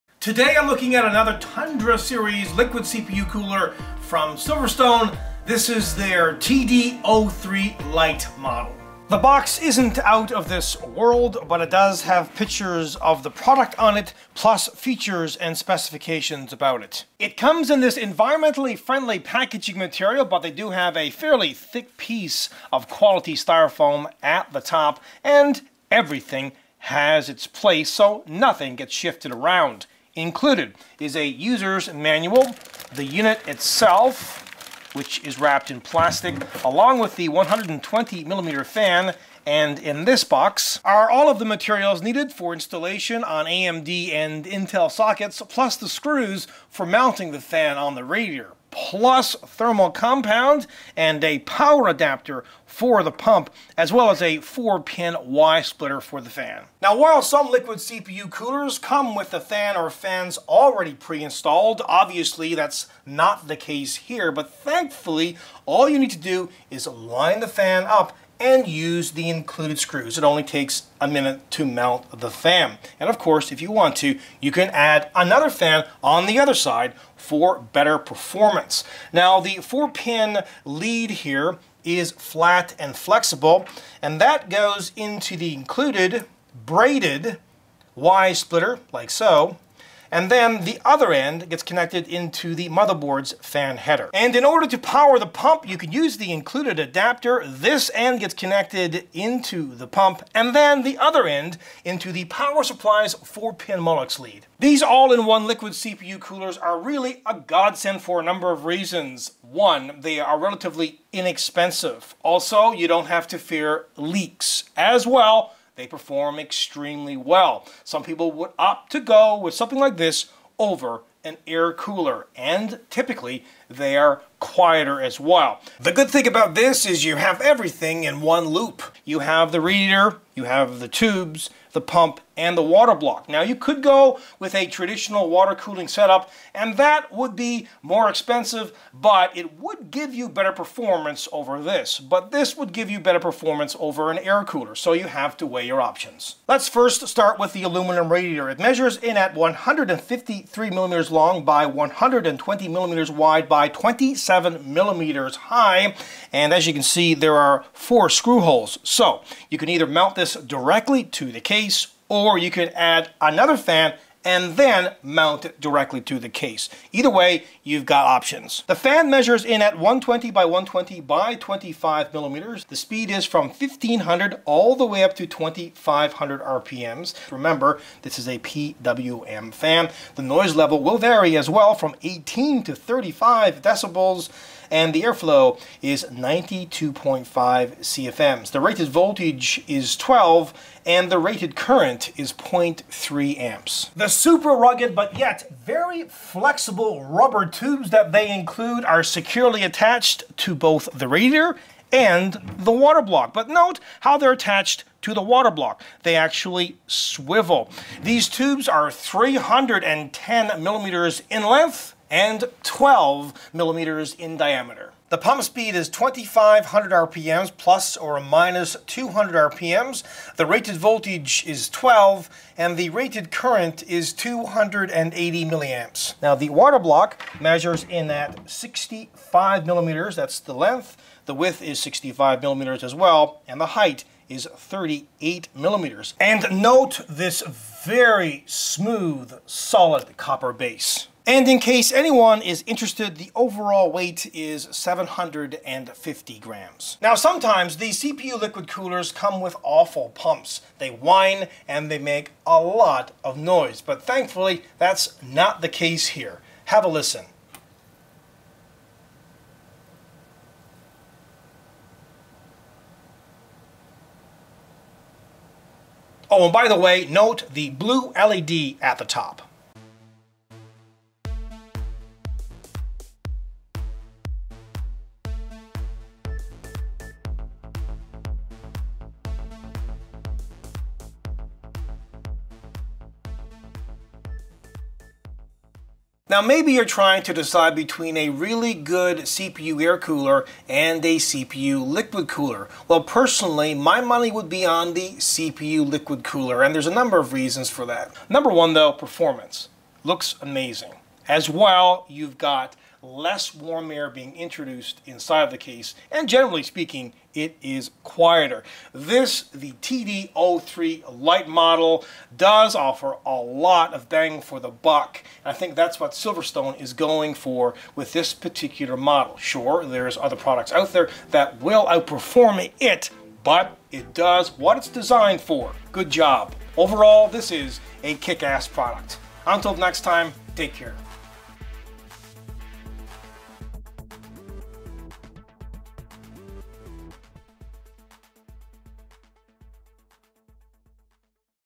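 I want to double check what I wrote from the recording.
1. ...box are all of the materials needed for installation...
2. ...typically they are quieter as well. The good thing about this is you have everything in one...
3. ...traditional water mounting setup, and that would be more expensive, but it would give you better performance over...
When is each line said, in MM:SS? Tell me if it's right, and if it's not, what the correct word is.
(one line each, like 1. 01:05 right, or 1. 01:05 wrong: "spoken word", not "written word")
1. 00:40 right
2. 02:02 right
3. 02:14 wrong: "cooling", not "mounting".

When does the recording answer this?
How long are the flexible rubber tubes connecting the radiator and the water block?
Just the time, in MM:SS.
03:28.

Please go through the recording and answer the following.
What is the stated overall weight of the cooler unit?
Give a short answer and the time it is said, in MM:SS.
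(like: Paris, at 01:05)
750 grams, at 04:04.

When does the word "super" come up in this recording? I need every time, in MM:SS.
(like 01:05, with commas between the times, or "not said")
03:14.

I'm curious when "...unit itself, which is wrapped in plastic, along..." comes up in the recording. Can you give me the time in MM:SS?
00:33.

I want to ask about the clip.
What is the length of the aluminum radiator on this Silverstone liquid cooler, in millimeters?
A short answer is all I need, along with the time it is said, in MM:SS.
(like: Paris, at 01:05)
153 millimeters, at 02:29.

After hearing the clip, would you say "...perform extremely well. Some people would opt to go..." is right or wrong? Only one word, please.
right.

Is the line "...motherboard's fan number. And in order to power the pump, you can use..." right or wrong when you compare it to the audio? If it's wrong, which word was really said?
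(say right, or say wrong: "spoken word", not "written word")
wrong: "header", not "number".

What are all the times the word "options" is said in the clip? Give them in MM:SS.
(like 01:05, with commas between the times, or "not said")
02:25, 02:48.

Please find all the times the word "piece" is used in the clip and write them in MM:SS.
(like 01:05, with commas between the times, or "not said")
00:21.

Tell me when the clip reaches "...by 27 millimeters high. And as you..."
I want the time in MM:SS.
02:33.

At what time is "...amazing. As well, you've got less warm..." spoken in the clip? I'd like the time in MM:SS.
05:00.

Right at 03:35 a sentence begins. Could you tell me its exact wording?
The pump speed is 2500 RPMs plus or minus 200 RPMs.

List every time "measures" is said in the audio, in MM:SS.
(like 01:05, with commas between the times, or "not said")
02:28, 02:49, 03:47.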